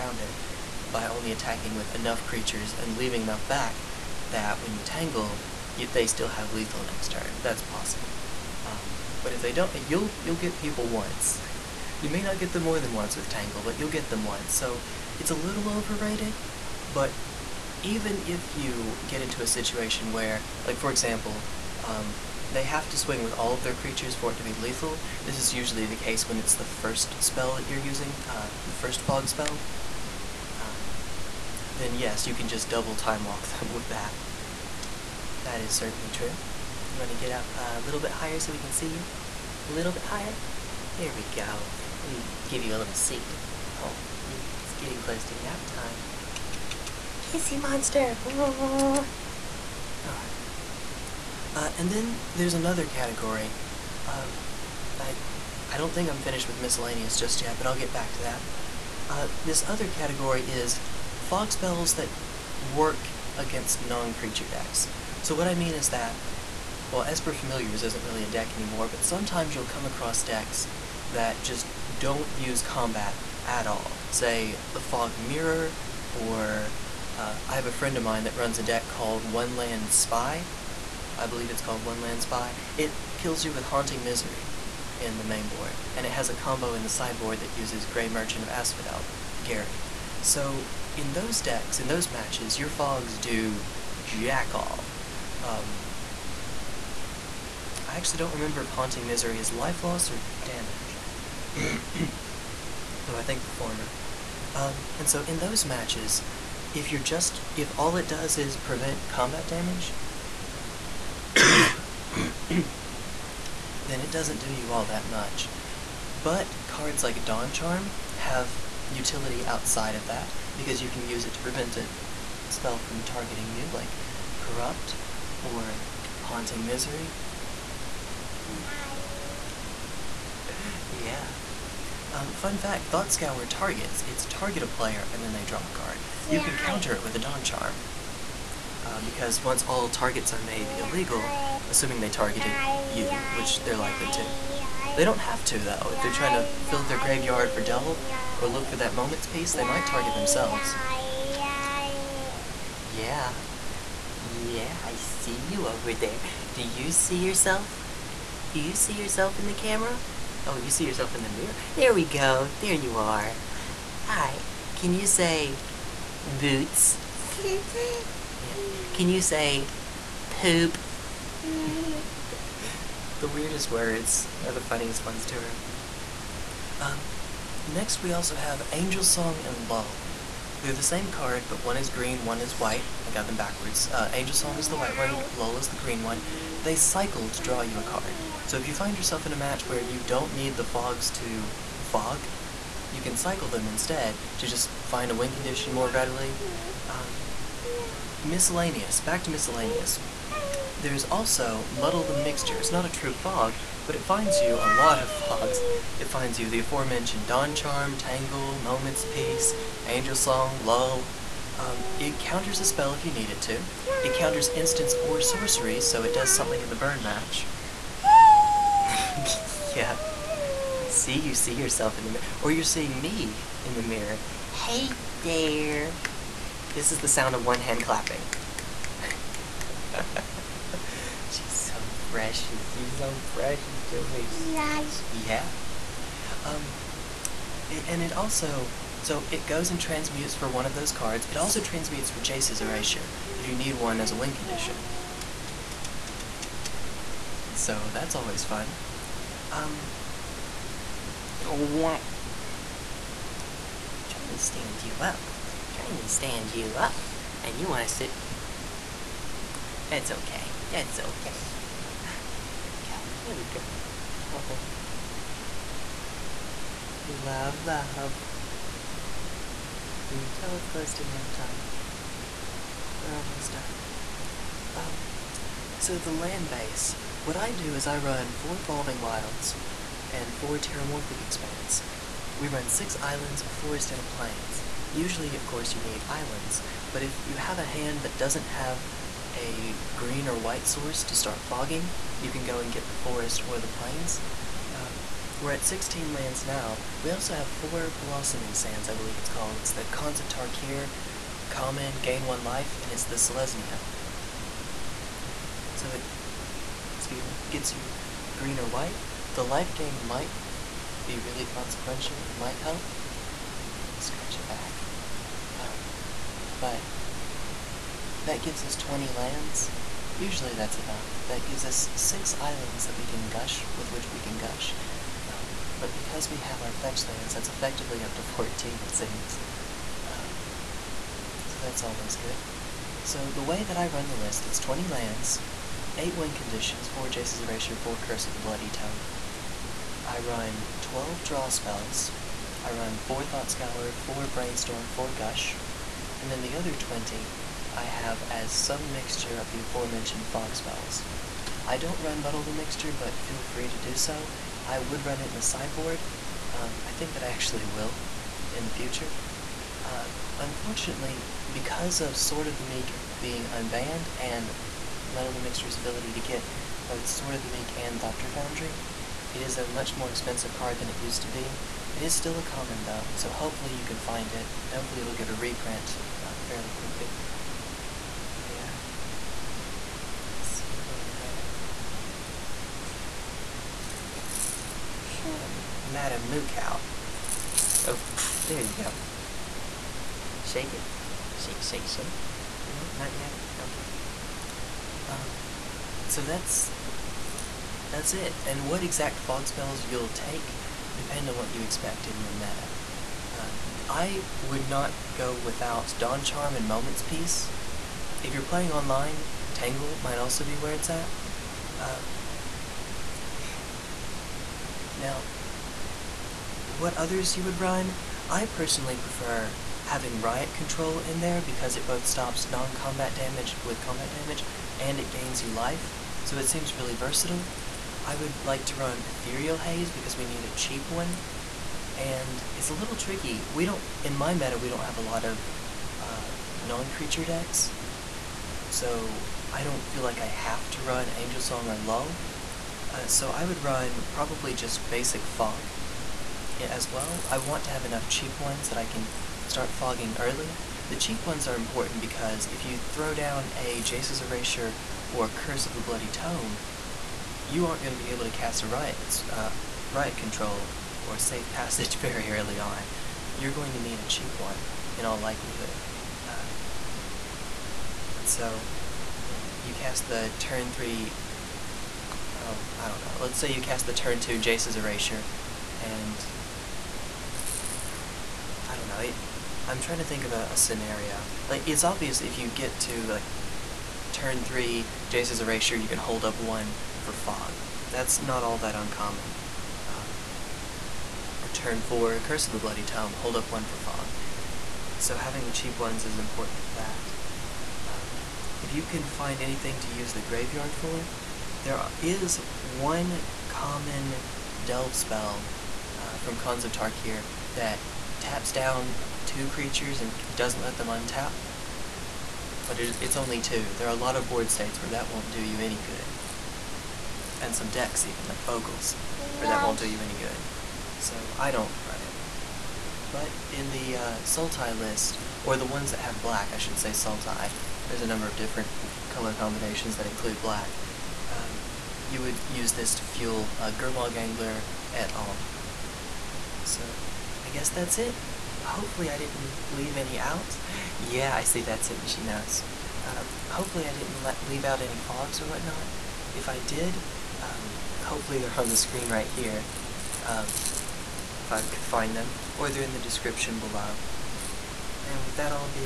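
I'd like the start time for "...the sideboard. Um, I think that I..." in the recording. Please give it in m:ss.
5:55.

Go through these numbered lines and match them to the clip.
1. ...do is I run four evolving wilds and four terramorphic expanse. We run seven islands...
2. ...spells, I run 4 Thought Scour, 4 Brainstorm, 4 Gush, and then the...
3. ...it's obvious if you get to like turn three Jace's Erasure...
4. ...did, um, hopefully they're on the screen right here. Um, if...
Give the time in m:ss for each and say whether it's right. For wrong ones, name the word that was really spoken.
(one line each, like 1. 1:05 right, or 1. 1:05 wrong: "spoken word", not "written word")
1. 4:37 wrong: "six", not "seven"
2. 5:41 right
3. 8:01 right
4. 9:06 right.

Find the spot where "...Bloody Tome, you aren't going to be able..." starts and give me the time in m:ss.
7:35.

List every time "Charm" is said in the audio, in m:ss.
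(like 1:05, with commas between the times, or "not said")
1:57, 2:17, 3:27, 6:46.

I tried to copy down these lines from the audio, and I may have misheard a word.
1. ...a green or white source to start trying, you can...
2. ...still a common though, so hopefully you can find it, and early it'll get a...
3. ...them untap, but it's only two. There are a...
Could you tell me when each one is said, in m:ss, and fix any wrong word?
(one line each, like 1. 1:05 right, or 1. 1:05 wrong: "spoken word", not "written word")
1. 4:49 wrong: "fogging", not "trying"
2. 6:12 wrong: "hopefully", not "early"
3. 8:30 right.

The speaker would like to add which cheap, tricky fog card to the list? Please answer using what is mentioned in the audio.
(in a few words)
Ethereal Haze.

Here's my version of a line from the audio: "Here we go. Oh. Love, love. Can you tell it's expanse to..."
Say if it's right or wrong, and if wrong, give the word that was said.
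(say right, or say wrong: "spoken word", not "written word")
wrong: "close", not "expanse".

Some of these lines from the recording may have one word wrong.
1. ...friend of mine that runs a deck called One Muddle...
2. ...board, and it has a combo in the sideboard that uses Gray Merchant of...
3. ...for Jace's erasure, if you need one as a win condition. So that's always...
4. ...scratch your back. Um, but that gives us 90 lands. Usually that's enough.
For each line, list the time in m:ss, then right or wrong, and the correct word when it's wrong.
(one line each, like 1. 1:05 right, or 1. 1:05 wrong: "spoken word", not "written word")
1. 1:17 wrong: "Land", not "Muddle"
2. 1:25 right
3. 4:02 right
4. 5:13 wrong: "20", not "90".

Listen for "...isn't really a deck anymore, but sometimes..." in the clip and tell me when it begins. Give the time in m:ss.
1:07.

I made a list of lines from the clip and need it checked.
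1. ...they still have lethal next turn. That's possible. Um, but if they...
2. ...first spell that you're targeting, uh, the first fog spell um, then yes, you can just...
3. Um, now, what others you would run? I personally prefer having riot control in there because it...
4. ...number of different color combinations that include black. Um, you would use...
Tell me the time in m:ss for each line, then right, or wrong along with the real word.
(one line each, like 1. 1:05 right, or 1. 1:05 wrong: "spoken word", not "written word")
1. 0:05 right
2. 0:26 wrong: "using", not "targeting"
3. 6:51 right
4. 8:48 right.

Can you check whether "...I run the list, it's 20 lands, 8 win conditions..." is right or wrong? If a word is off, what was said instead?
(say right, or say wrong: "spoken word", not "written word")
right.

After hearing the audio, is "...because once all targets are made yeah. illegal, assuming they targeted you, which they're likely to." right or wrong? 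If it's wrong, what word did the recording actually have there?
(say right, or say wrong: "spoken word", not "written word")
right.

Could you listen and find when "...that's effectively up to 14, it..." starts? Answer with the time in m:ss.
5:27.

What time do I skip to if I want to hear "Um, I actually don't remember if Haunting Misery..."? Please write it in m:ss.
1:35.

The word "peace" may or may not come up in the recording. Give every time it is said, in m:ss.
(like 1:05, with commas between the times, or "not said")
2:29, 3:29, 6:47.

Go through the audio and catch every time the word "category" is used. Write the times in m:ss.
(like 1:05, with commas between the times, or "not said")
0:52, 0:59.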